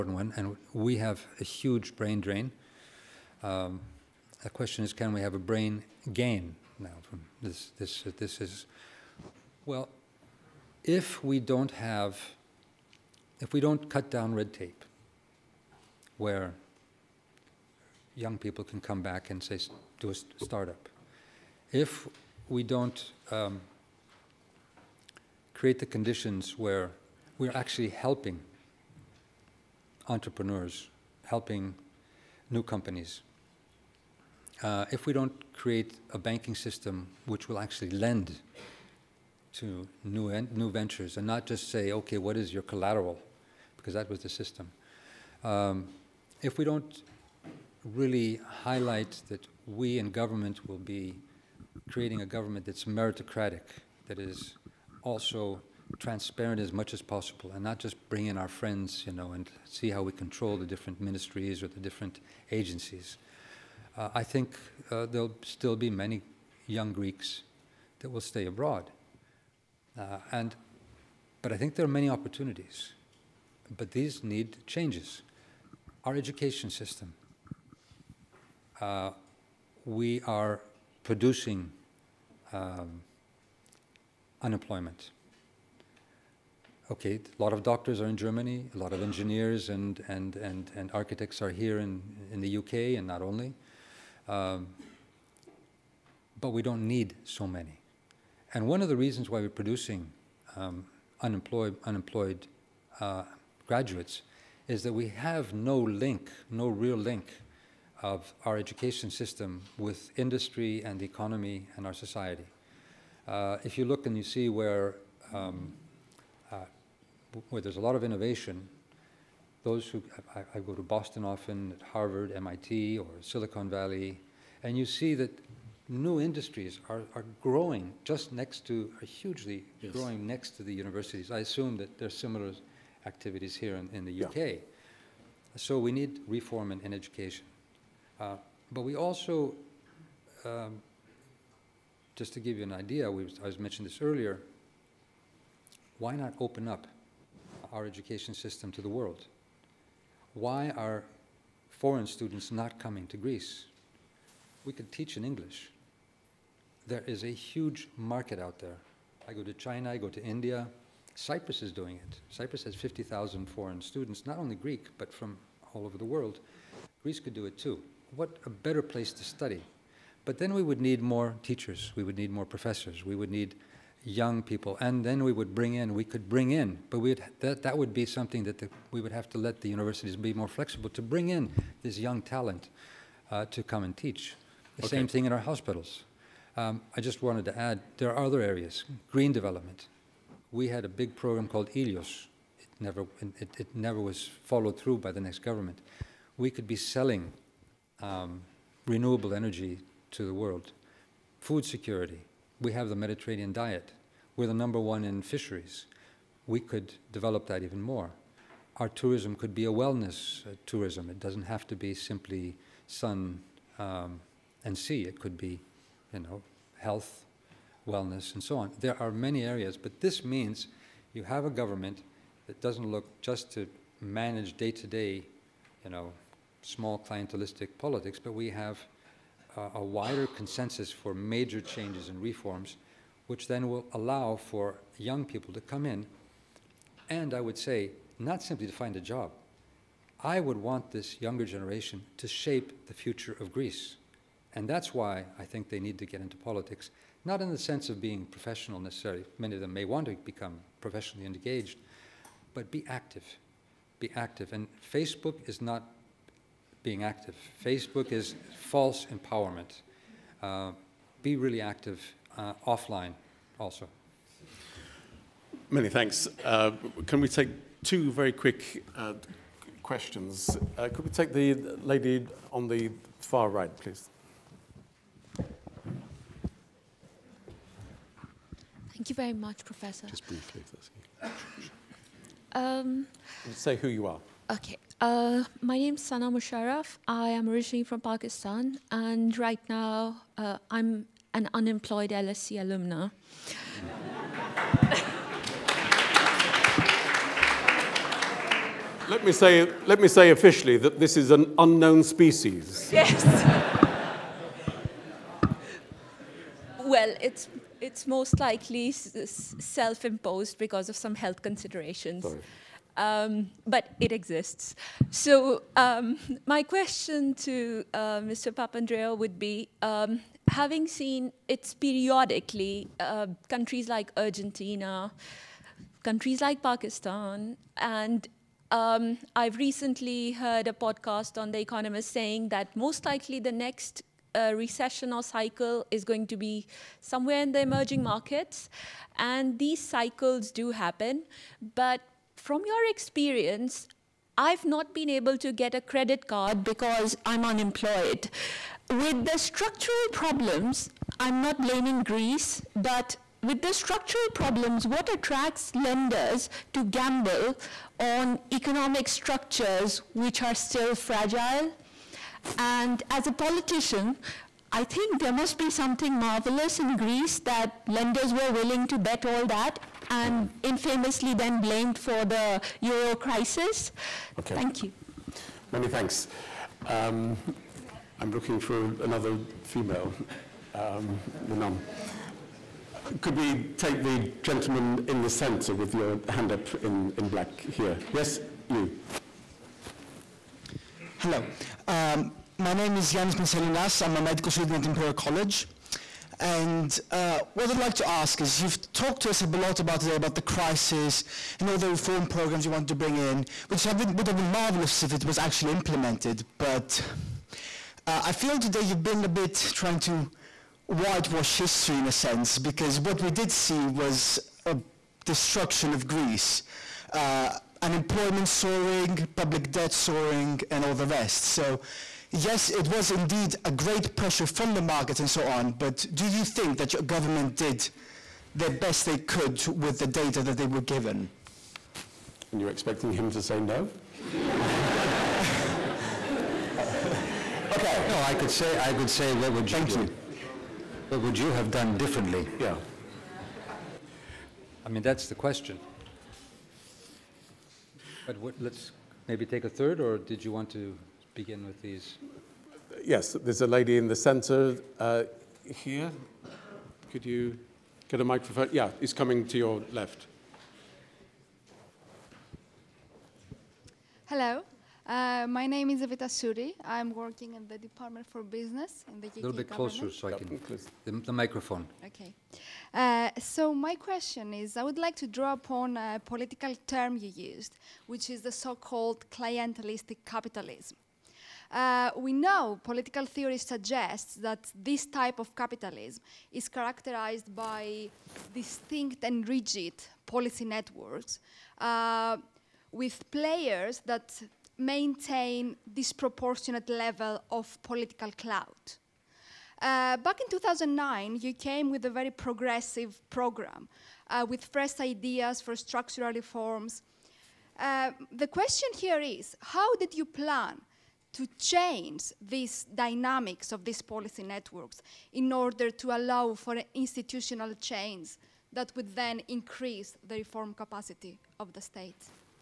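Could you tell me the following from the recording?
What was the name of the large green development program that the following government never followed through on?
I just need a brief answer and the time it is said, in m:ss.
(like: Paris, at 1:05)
Ilios, at 3:11.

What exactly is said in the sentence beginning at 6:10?
infamously then blamed for the euro crisis.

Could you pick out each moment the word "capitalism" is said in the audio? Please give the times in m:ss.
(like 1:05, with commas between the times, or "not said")
8:00, 8:05.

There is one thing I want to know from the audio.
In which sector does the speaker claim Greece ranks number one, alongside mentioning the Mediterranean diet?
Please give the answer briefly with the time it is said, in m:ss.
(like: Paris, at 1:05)
Fisheries, at 3:25.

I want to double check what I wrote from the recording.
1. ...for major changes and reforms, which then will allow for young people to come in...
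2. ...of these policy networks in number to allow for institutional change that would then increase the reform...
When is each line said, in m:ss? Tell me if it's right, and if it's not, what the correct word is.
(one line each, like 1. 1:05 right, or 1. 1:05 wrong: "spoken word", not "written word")
1. 3:50 right
2. 8:33 wrong: "order", not "number".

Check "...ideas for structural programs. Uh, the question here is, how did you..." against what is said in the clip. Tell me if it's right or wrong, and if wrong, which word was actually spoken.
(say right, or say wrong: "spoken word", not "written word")
wrong: "reforms", not "programs".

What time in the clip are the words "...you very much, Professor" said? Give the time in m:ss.
4:39.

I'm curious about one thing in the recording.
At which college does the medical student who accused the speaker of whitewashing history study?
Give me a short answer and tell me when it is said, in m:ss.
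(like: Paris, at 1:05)
Imperial College, at 6:34.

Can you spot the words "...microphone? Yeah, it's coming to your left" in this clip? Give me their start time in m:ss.
7:38.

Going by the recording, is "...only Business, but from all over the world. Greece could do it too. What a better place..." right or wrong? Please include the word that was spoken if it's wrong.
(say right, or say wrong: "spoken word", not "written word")
wrong: "Greek", not "Business".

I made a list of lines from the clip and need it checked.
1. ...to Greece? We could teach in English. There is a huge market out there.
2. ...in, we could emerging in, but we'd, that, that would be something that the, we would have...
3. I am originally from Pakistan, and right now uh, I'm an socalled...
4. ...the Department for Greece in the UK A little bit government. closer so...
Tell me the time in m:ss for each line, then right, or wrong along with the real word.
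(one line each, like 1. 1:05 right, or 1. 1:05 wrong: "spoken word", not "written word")
1. 2:33 right
2. 2:55 wrong: "bring", not "emerging"
3. 4:47 wrong: "unemployed", not "socalled"
4. 7:47 wrong: "Business", not "Greece".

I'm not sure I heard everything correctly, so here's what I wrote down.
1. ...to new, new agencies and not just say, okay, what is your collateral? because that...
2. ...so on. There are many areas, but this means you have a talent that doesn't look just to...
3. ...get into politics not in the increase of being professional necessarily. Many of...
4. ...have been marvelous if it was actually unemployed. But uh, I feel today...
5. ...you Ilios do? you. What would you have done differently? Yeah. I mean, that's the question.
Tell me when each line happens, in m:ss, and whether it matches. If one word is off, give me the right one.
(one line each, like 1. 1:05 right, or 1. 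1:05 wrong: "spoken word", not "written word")
1. 0:39 wrong: "ventures", not "agencies"
2. 3:38 wrong: "government", not "talent"
3. 4:06 wrong: "sense", not "increase"
4. 6:44 wrong: "implemented", not "unemployed"
5. 7:19 wrong: "Thank", not "Ilios".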